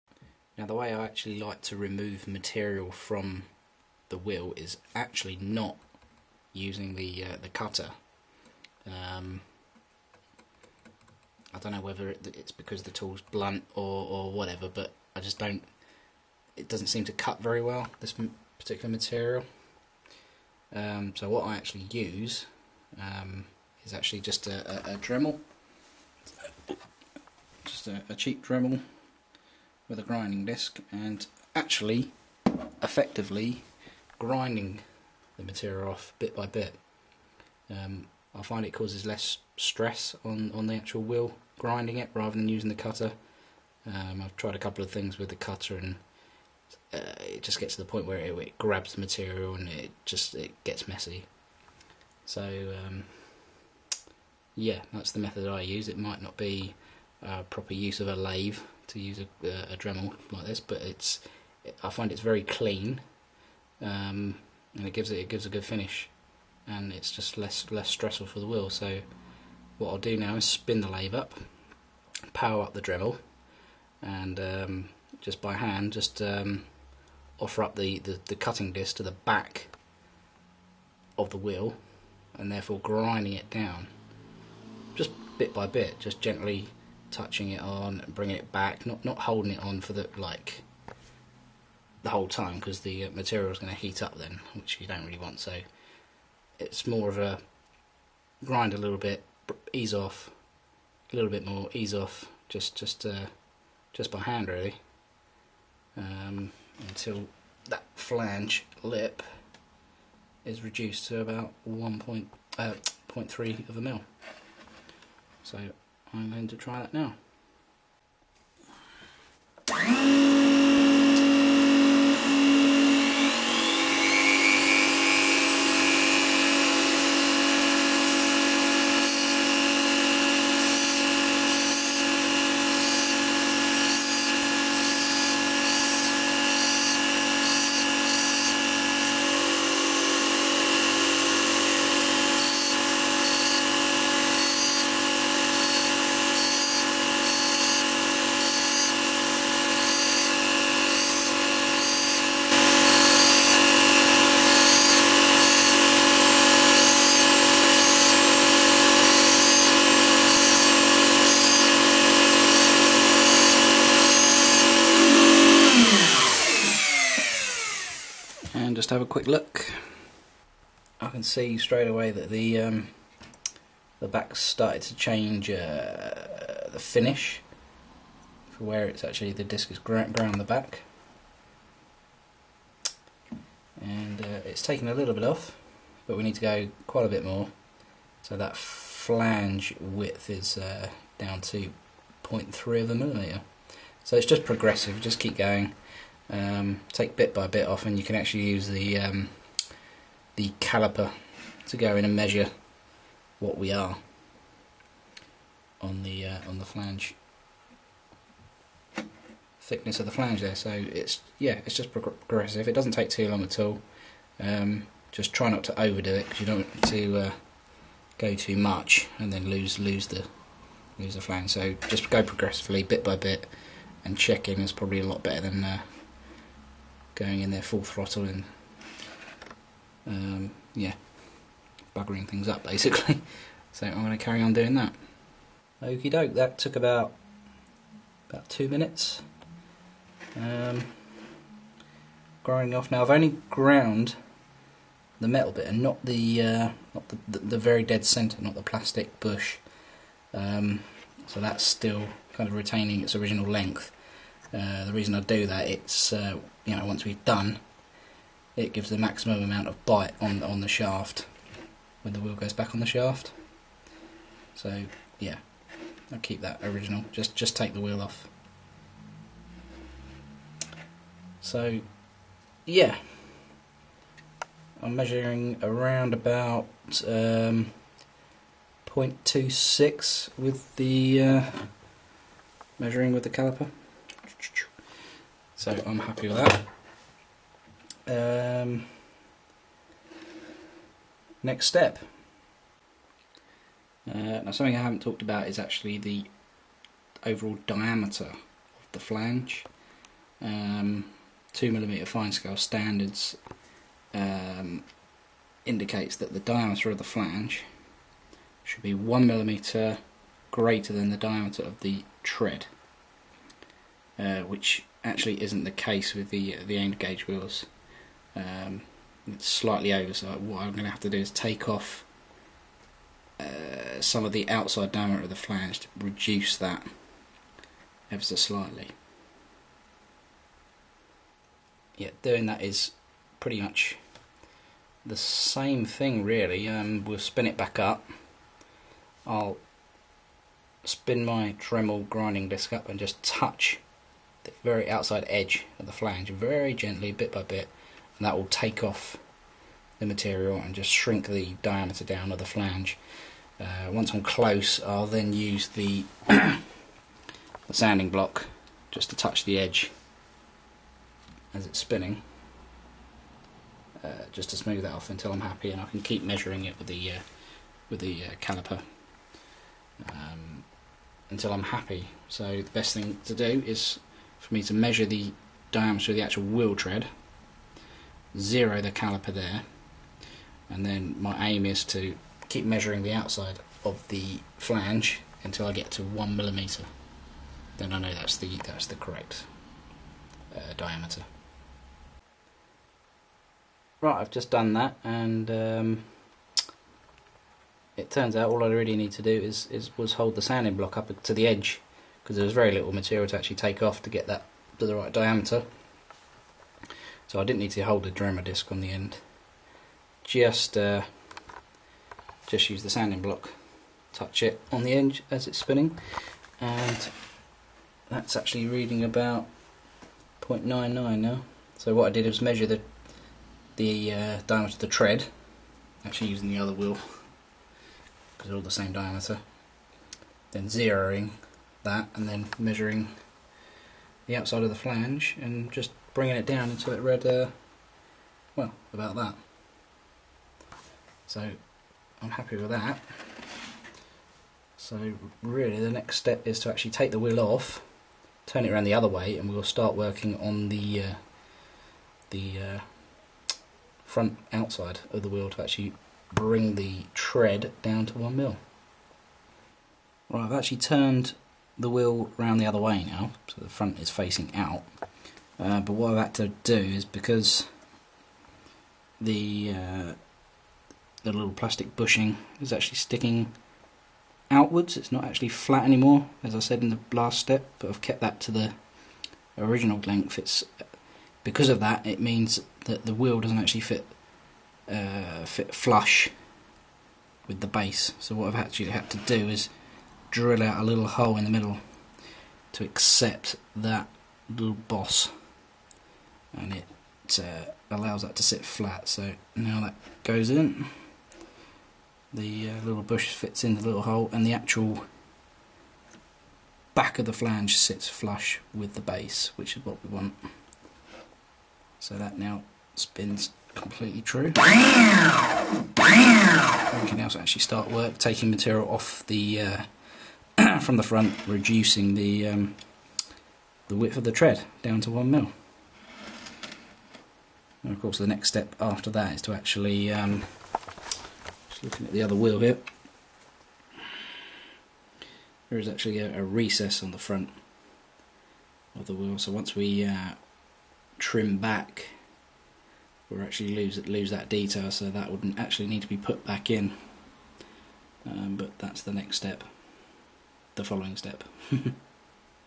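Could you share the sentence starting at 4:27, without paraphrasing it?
Just, just take the wheel off.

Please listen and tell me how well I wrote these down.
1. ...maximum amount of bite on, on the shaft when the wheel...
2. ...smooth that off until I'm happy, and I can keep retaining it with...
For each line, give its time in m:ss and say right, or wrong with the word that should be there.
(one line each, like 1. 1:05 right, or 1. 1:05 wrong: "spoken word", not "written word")
1. 4:18 right
2. 6:04 wrong: "measuring", not "retaining".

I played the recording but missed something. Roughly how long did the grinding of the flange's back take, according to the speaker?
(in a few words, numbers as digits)
about two minutes.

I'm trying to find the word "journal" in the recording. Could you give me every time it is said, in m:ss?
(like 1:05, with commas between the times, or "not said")
not said.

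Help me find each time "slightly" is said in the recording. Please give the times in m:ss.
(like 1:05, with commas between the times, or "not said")
5:19, 5:28.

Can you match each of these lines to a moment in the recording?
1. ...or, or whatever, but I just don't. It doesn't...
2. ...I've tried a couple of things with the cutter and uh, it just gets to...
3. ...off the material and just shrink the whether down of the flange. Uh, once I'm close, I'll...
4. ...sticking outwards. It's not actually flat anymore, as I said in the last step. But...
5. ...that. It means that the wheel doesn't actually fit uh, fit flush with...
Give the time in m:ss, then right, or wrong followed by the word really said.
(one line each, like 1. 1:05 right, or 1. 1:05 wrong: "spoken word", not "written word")
1. 0:13 right
2. 0:44 right
3. 5:48 wrong: "diameter", not "whether"
4. 7:52 right
5. 8:01 right.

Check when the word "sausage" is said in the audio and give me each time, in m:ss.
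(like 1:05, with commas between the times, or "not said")
not said.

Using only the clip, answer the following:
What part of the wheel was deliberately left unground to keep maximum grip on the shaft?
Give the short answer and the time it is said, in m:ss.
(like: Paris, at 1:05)
plastic bush, at 4:08.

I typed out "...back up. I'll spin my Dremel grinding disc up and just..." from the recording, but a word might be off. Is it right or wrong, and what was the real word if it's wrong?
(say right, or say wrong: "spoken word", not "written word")
right.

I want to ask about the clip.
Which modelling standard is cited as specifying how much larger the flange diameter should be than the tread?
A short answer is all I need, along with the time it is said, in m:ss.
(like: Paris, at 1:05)
2mm fine scale, at 5:01.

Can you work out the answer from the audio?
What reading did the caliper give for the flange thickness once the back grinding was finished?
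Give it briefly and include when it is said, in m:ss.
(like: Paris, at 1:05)
0.26, at 4:38.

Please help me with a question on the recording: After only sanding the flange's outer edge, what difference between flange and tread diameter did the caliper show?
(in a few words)
0.99.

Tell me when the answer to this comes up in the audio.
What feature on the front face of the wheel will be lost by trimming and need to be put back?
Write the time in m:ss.
8:56.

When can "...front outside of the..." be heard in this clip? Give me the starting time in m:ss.
7:34.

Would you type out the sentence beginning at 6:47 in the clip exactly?
So I didn't need to hold the dremel disc on the end.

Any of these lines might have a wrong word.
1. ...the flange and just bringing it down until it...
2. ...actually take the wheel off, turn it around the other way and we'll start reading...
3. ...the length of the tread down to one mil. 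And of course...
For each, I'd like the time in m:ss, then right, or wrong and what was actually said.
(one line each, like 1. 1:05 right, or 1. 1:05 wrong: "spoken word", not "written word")
1. 7:14 right
2. 7:26 wrong: "working", not "reading"
3. 8:43 wrong: "width", not "length".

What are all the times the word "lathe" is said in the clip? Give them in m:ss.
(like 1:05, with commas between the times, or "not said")
0:58, 1:10.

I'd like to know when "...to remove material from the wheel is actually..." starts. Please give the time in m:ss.
0:01.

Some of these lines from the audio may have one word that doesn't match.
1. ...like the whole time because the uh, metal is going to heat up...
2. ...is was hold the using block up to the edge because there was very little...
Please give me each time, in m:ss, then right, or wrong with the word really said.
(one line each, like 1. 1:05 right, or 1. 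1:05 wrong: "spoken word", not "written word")
1. 1:30 wrong: "material", not "metal"
2. 6:39 wrong: "sanding", not "using".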